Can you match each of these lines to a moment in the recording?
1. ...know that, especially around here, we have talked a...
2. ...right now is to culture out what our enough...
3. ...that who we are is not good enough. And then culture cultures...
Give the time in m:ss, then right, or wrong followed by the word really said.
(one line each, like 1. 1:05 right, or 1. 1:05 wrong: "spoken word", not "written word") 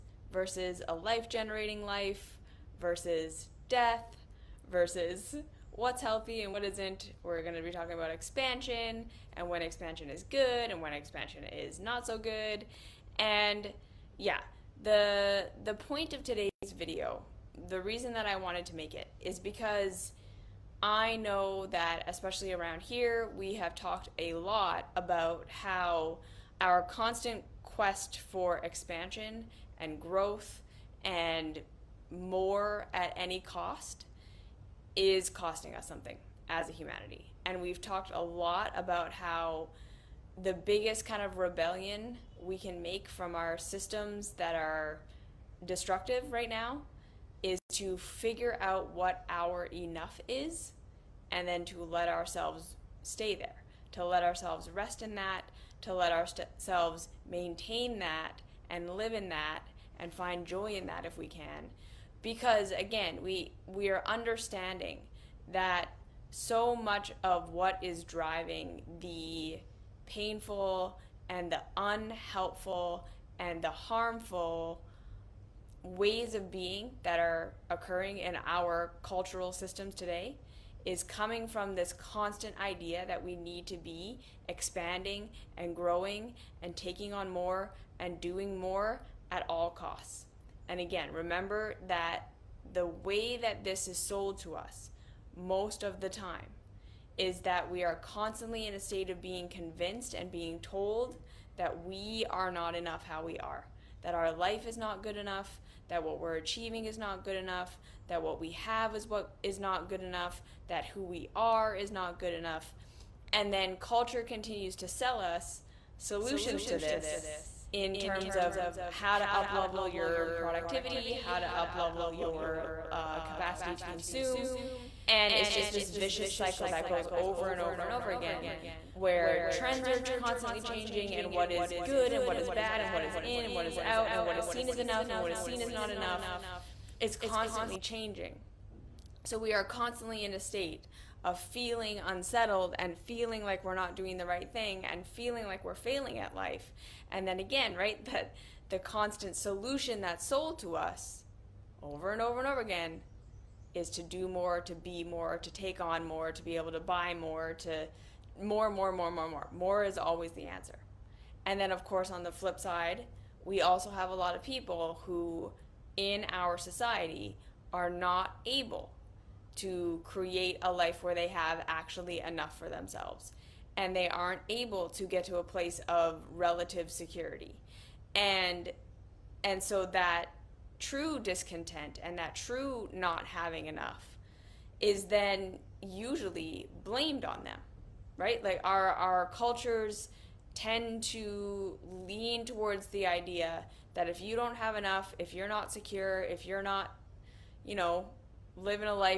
1. 0:21 right
2. 0:46 wrong: "figure", not "culture"
3. 1:50 wrong: "continues", not "cultures".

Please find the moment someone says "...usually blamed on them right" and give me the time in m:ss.
3:05.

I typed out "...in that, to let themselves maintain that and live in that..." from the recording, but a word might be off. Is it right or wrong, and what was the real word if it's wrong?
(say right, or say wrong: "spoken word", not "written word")
wrong: "ourselves", not "themselves".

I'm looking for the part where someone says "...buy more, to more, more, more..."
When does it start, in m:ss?
2:36.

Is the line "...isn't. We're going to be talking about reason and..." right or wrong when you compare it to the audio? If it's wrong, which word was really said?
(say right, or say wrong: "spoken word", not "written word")
wrong: "expansion", not "reason".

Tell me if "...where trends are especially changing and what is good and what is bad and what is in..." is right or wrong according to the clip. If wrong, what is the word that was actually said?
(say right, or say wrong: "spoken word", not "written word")
wrong: "constantly", not "especially".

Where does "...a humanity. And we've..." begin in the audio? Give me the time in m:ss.
0:36.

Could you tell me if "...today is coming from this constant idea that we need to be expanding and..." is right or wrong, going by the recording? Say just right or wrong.
right.